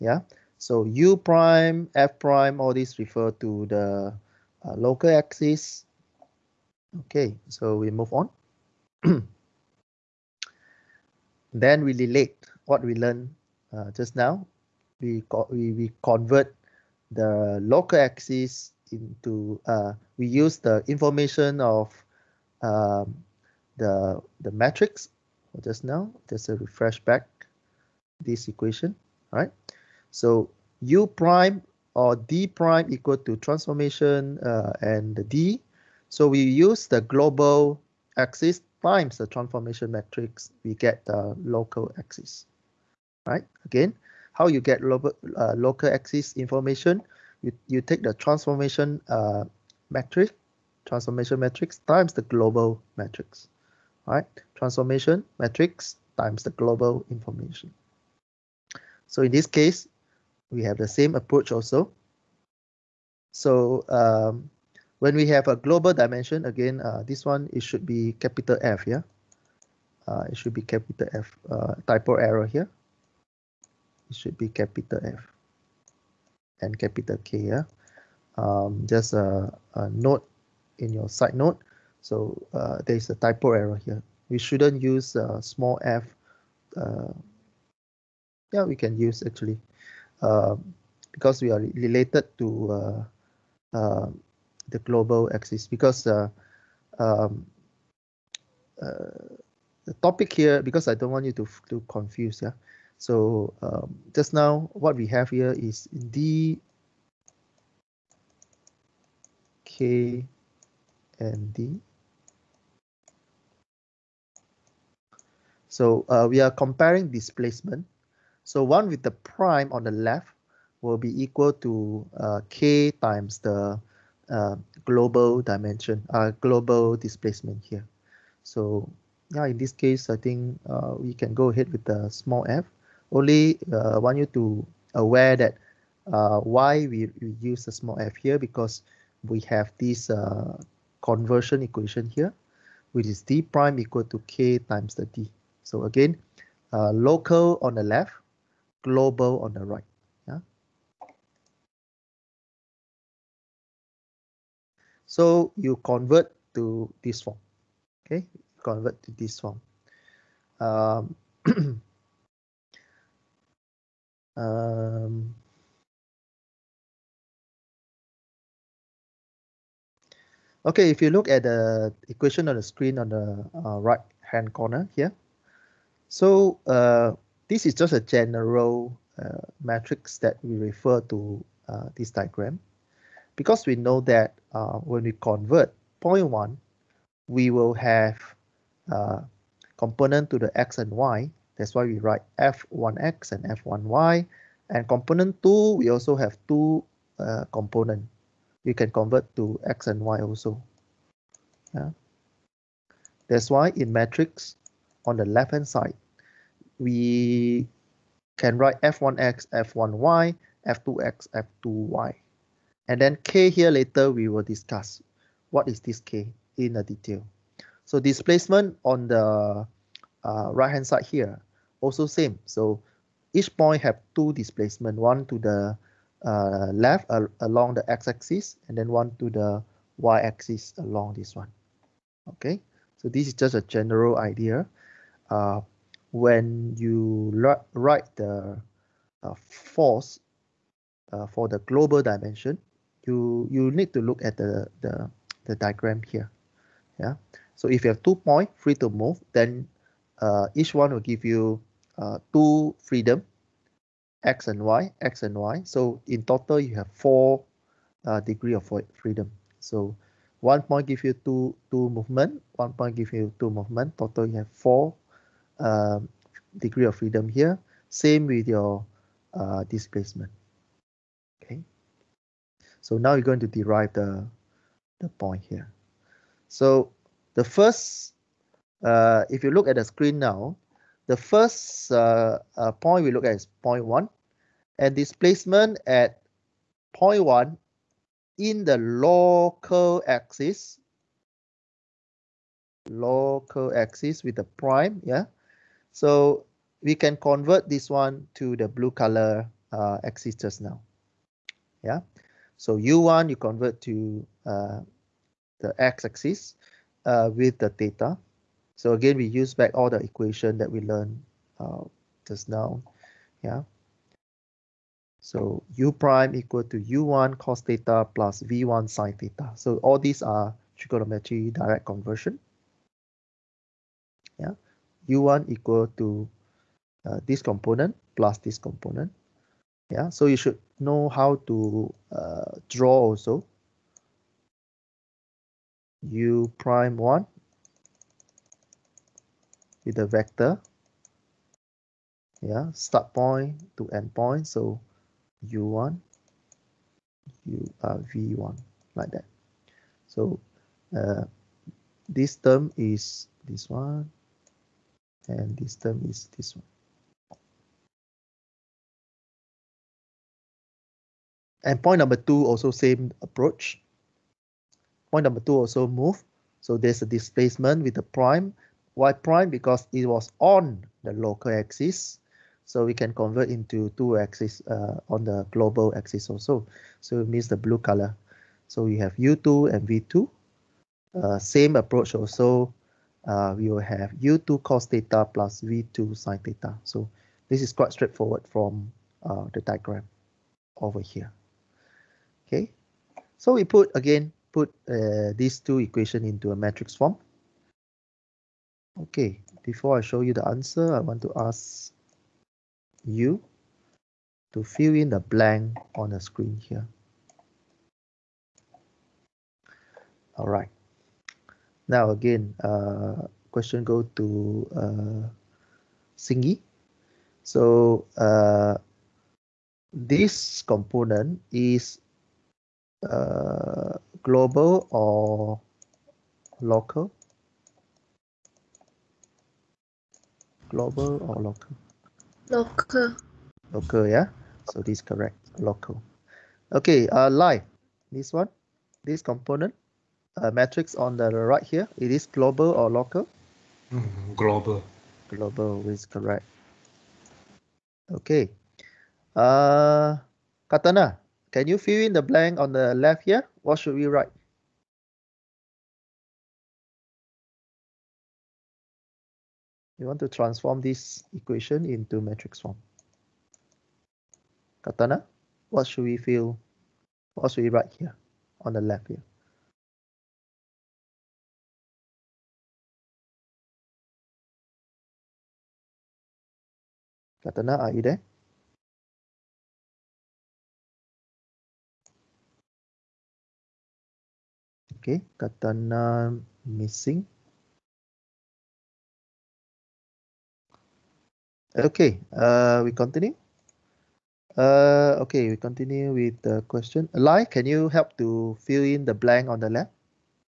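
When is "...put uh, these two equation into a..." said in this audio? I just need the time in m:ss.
6:34.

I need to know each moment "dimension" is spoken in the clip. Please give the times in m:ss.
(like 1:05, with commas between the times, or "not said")
1:05, 2:05, 4:02.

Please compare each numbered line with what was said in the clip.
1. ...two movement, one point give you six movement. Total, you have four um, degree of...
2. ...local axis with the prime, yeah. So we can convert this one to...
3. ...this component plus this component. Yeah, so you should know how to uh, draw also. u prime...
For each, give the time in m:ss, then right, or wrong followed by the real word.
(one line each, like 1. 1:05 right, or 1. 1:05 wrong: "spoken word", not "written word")
1. 4:21 wrong: "two", not "six"
2. 4:52 right
3. 5:27 right.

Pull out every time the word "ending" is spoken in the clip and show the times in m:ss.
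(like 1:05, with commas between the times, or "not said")
not said.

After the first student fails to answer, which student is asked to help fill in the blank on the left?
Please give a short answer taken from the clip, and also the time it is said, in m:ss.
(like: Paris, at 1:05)
Lai, at 8:17.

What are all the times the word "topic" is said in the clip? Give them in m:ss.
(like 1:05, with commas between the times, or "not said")
1:40.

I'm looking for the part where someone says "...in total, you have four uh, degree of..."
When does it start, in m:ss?
4:16.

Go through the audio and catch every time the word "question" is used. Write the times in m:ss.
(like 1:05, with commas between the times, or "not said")
6:53, 8:16.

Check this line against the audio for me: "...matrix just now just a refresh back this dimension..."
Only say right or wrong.
wrong.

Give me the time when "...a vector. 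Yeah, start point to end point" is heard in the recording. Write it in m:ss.
5:39.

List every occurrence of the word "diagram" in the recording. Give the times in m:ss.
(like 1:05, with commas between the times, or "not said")
3:02, 4:05, 6:29.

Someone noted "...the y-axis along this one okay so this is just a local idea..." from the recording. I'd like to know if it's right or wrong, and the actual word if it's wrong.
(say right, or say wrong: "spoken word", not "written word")
wrong: "general", not "local".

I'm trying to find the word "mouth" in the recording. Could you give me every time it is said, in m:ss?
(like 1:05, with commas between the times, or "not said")
not said.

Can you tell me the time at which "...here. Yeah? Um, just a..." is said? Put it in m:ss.
1:17.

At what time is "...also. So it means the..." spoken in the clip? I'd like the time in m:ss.
6:16.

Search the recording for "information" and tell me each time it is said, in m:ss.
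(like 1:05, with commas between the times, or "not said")
0:20, 0:46, 0:57.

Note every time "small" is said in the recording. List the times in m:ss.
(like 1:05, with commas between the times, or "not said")
1:25, 2:12, 2:17.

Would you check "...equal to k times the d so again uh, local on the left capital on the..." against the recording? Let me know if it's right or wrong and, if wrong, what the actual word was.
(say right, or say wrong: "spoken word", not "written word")
wrong: "global", not "capital".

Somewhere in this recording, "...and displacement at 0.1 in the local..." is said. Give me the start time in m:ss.
4:44.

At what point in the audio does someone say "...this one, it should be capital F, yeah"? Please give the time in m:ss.
1:07.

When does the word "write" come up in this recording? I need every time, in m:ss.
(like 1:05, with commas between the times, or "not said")
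3:11, 3:28, 3:57, 7:34, 7:47.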